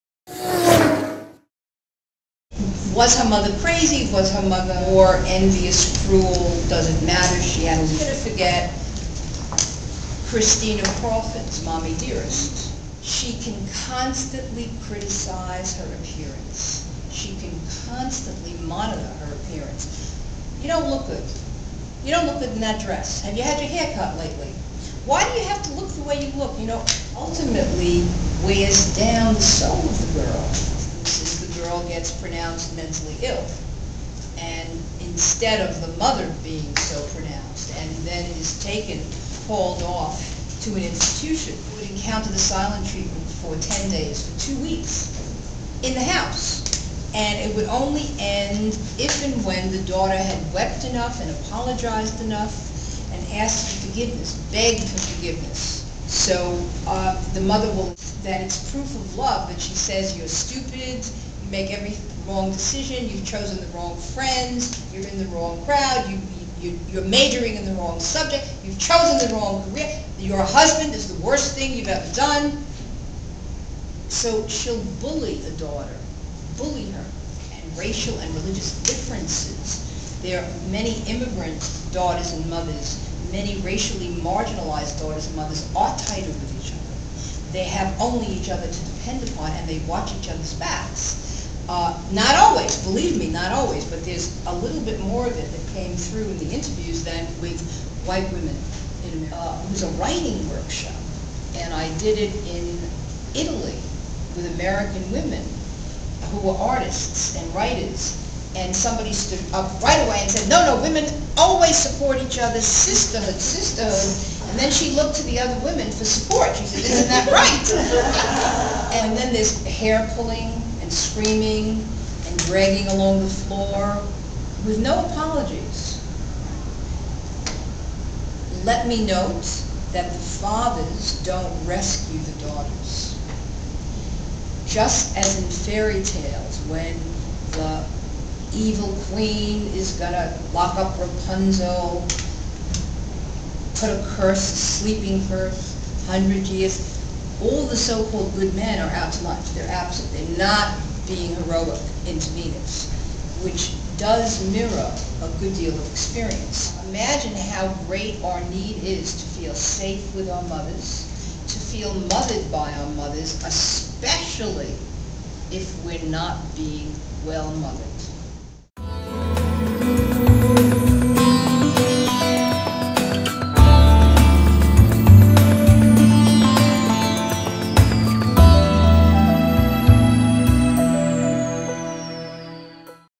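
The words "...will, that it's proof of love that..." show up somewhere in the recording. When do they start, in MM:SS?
00:57.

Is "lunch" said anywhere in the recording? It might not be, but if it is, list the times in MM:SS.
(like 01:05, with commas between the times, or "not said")
02:29.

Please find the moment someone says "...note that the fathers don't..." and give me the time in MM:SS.
02:09.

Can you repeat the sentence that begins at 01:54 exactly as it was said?
And then she looked to the other women for support.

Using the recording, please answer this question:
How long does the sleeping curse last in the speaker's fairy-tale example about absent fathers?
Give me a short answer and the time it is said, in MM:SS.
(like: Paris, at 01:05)
100 years, at 02:26.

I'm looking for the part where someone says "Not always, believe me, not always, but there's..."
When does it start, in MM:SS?
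01:32.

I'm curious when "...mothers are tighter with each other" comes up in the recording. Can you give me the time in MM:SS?
01:25.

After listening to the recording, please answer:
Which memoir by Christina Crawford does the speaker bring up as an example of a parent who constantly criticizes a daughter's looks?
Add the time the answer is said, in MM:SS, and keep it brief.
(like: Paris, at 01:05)
Mommy Dearest, at 00:11.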